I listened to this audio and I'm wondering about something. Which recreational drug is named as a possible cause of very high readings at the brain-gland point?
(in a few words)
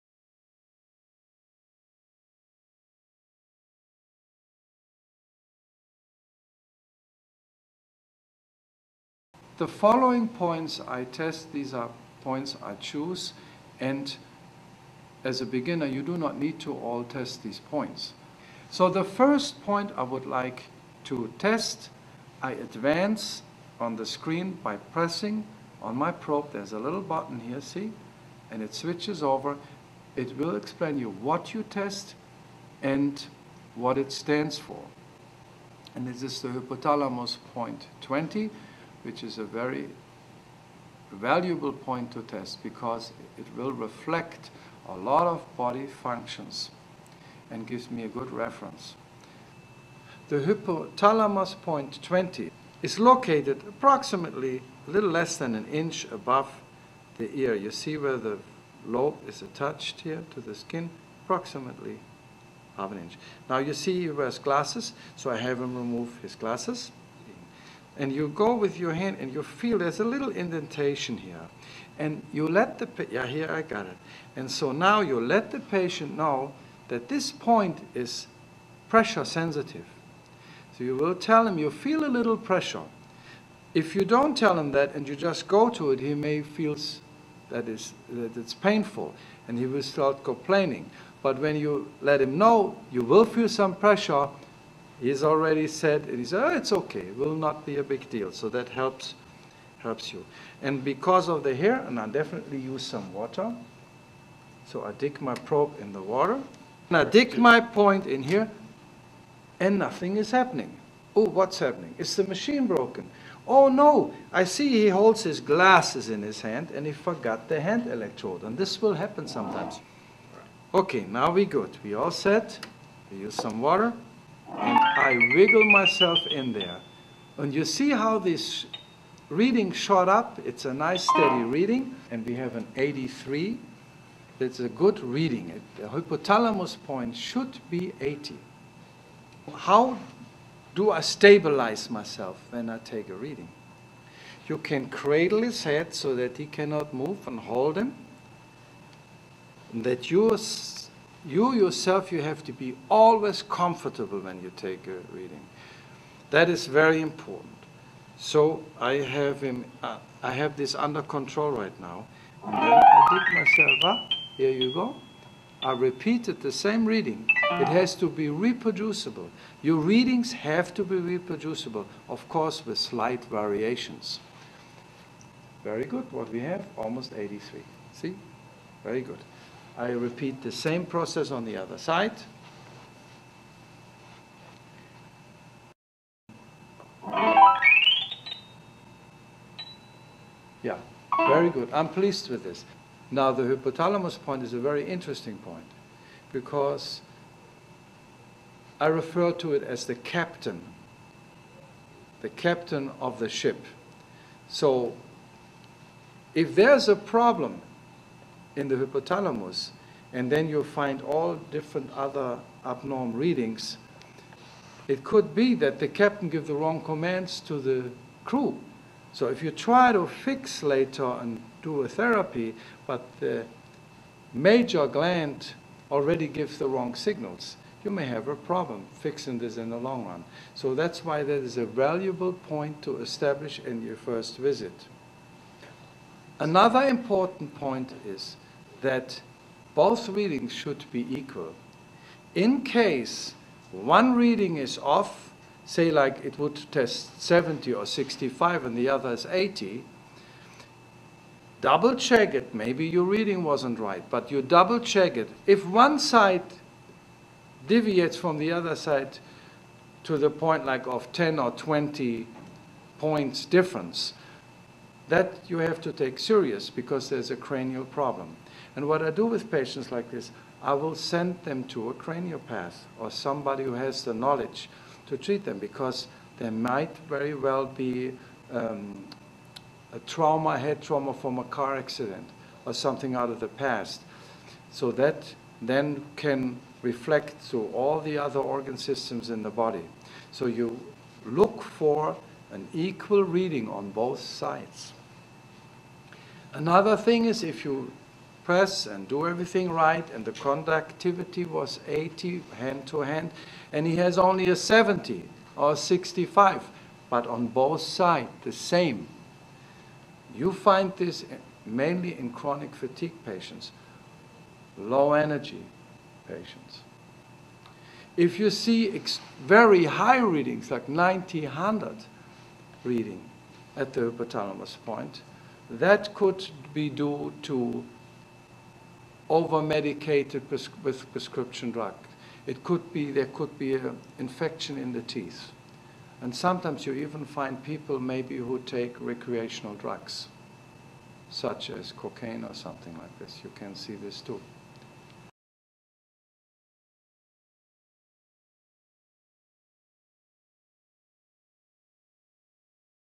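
cocaine.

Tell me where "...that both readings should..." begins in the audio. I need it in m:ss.
3:58.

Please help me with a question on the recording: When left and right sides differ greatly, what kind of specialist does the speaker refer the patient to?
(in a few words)
a craniopath.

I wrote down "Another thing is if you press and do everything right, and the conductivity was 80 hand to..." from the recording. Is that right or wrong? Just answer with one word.
right.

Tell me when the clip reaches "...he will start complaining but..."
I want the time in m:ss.
1:29.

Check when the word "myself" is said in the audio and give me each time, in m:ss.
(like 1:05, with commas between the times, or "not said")
2:05, 2:21, 2:43.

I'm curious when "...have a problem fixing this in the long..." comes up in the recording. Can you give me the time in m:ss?
3:48.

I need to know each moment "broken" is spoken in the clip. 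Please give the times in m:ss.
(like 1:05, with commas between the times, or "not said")
1:52.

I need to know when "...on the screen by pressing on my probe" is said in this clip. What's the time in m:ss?
0:23.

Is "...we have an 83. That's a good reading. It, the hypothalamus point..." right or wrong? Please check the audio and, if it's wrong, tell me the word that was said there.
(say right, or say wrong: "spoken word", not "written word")
right.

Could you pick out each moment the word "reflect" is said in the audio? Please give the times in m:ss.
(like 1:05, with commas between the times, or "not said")
0:43, 4:46.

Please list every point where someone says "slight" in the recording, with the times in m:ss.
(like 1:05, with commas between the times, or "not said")
2:52.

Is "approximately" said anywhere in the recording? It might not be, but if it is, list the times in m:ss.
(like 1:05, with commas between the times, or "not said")
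0:53, 1:01.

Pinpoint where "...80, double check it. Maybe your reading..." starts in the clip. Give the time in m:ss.
4:09.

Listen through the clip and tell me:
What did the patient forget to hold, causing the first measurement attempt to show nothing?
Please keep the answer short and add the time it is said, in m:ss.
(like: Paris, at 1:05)
hand electrode, at 1:57.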